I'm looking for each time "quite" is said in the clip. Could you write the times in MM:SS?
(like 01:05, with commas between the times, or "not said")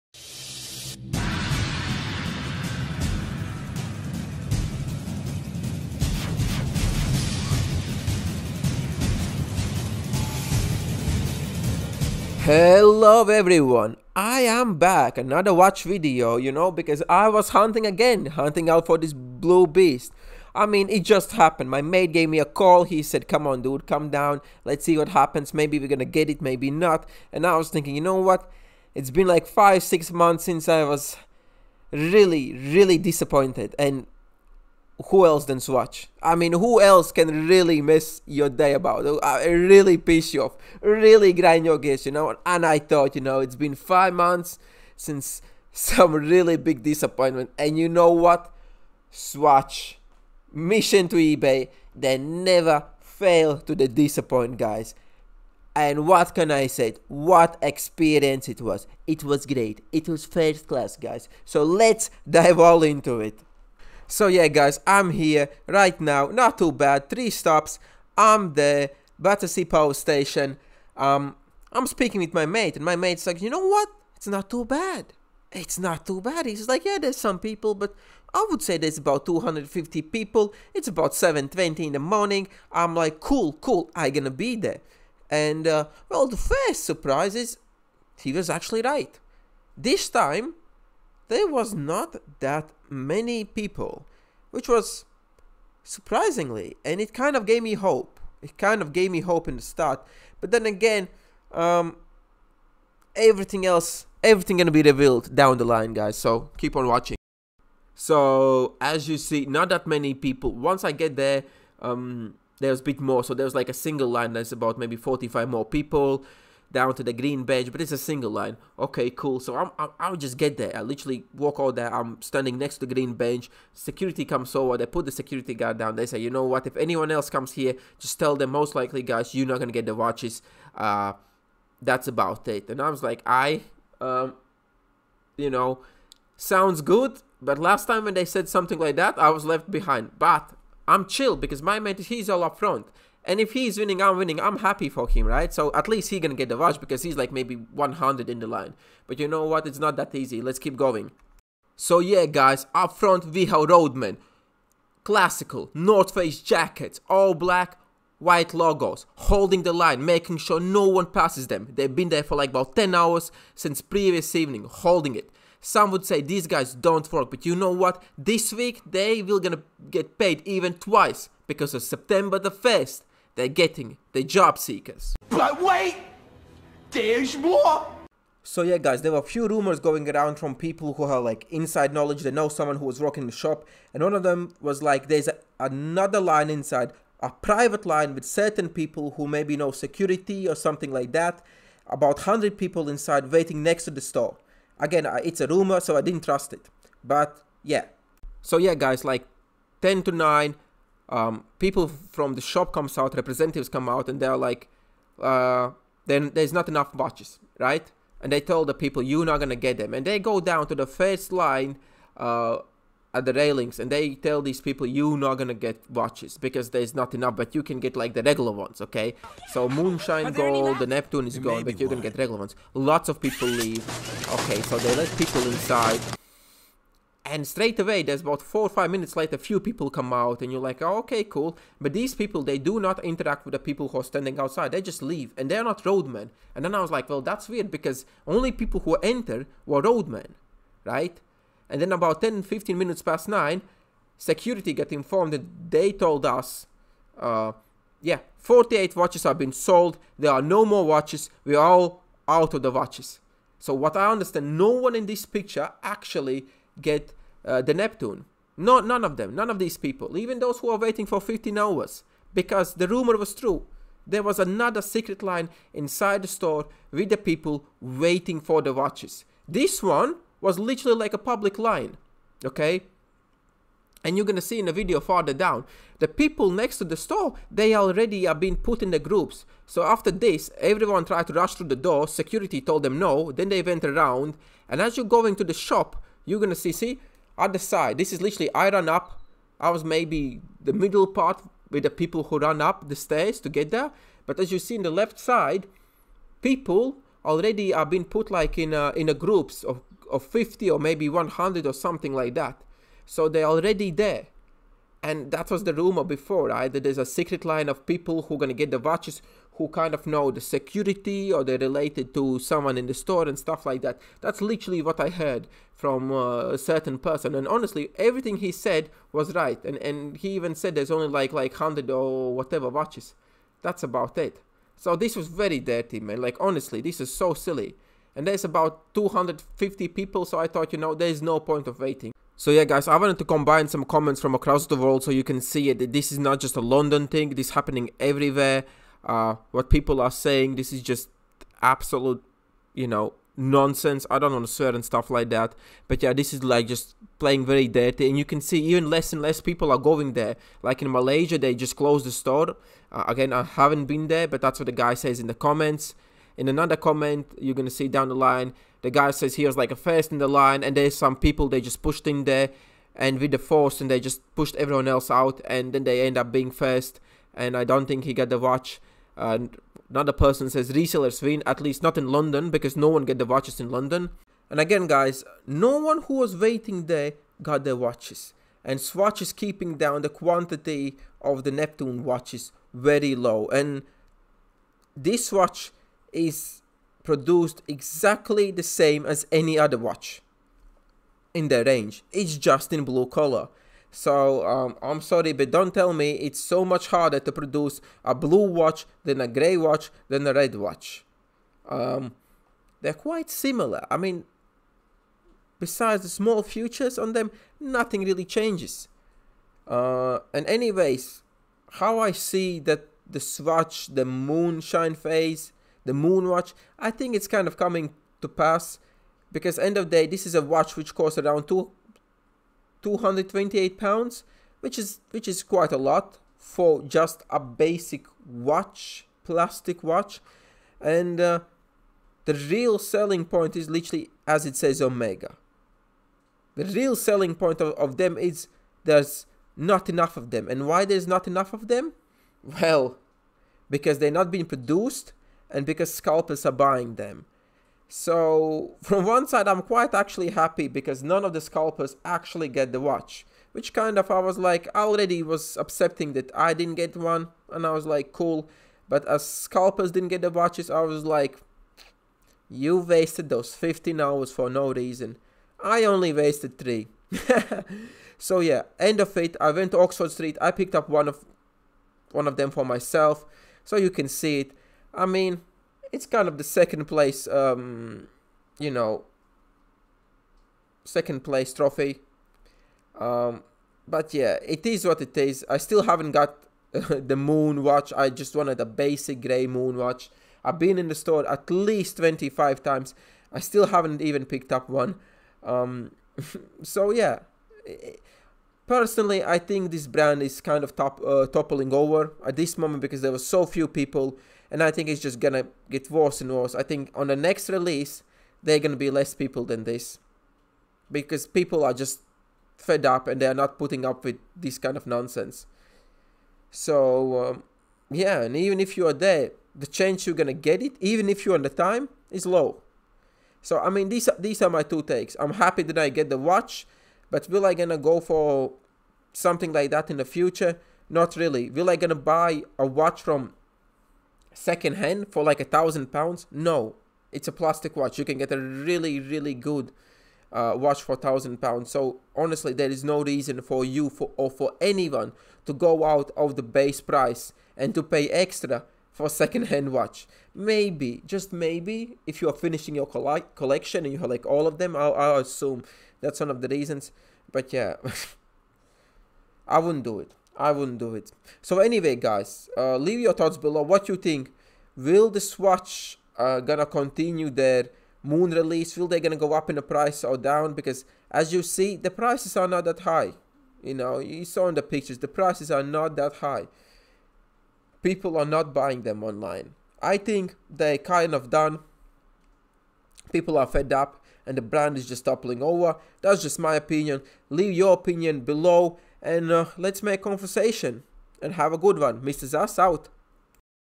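06:42, 07:05, 07:29.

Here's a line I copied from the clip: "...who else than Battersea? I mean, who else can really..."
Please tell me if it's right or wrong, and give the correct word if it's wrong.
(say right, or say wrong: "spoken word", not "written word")
wrong: "Swatch", not "Battersea".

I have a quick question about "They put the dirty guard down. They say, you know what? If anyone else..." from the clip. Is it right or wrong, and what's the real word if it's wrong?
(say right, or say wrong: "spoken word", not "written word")
wrong: "security", not "dirty".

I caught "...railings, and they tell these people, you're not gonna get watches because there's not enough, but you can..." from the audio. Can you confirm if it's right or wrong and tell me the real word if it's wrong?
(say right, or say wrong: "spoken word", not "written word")
right.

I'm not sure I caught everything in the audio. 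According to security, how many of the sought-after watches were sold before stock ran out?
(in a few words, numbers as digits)
48.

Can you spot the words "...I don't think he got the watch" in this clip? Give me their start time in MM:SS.
06:07.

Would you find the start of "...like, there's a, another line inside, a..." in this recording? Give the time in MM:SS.
03:04.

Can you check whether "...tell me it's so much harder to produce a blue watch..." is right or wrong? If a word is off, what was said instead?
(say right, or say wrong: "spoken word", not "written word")
right.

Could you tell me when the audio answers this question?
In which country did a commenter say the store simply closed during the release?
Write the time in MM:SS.
05:50.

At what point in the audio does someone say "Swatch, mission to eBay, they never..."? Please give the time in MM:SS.
00:49.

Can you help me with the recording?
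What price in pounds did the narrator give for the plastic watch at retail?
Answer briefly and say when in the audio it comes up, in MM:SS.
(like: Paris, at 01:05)
228 pounds, at 07:02.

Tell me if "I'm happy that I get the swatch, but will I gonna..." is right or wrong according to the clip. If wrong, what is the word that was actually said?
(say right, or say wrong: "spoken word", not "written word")
wrong: "watch", not "swatch".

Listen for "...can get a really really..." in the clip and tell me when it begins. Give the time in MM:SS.
08:58.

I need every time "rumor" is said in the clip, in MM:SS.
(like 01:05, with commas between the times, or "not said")
02:59, 03:15, 04:22, 05:05.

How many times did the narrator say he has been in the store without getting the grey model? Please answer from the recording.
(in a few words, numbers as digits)
25.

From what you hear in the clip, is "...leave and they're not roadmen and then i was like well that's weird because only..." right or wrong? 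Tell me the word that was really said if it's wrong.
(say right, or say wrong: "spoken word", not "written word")
right.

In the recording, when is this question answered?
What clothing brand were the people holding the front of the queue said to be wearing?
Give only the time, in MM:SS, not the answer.
02:35.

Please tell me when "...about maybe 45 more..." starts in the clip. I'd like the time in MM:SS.
01:54.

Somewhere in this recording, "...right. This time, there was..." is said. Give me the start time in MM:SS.
01:28.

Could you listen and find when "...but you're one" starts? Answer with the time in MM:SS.
03:41.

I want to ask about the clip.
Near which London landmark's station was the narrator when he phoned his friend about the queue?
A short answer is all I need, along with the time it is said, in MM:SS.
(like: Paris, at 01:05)
Battersea Power Station, at 01:09.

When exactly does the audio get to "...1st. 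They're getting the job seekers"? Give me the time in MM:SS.
02:52.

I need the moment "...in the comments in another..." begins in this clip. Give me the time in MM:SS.
05:55.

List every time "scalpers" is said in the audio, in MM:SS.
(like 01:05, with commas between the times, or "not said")
07:25, 07:31, 07:39.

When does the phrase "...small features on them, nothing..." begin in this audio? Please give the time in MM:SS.
06:46.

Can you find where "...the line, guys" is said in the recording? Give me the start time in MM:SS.
01:45.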